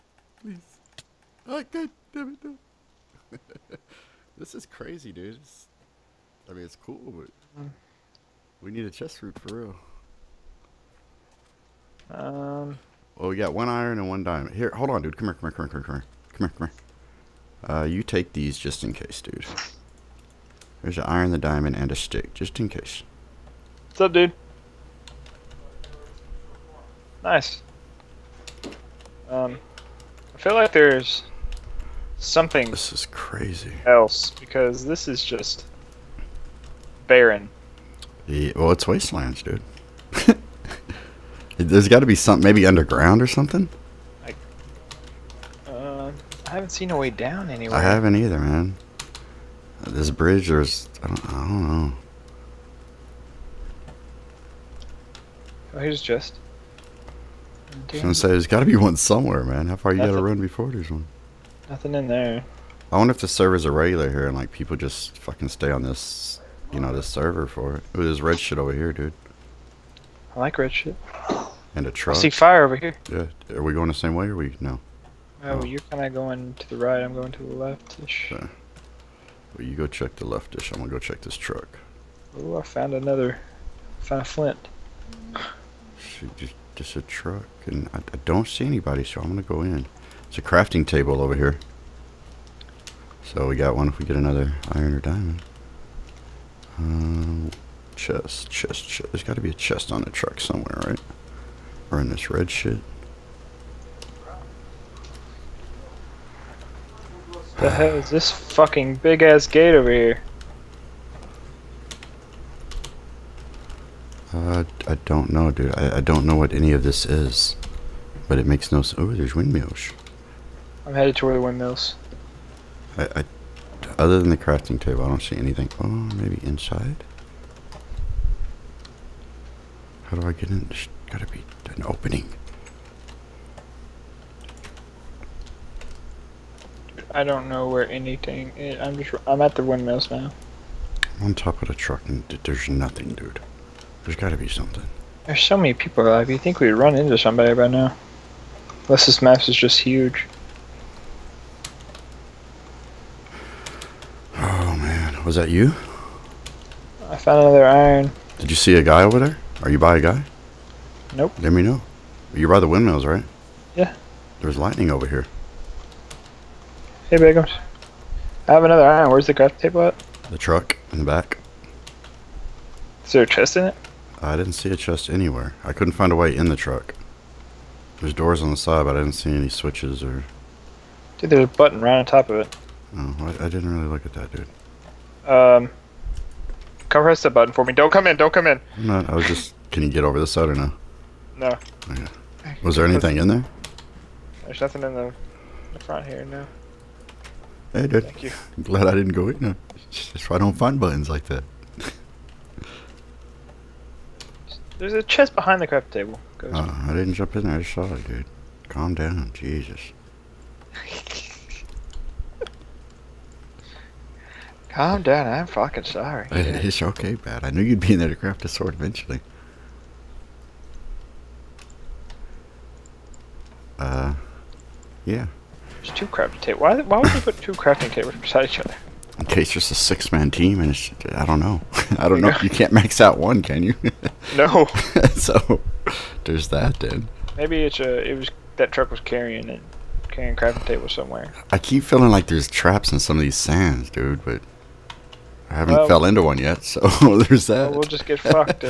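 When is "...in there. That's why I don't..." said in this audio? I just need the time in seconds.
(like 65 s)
199 s.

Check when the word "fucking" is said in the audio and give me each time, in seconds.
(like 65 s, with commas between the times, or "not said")
65 s, 108 s, 215 s.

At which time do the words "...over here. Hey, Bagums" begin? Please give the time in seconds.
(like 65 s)
164 s.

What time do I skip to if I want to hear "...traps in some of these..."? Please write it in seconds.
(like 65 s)
242 s.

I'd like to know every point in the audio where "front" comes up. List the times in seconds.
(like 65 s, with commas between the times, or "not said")
195 s.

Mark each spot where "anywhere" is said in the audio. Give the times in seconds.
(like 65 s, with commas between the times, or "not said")
47 s, 175 s.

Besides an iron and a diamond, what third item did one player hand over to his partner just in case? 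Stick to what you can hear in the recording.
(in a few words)
A stick.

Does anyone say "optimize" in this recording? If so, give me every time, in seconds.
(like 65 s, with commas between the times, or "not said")
not said.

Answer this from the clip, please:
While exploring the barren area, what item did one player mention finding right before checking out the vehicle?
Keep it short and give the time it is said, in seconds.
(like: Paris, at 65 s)
Flint, at 84 s.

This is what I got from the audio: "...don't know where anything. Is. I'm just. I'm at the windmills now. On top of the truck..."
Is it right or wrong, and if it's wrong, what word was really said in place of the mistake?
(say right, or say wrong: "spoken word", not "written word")
right.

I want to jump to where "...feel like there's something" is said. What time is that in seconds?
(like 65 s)
30 s.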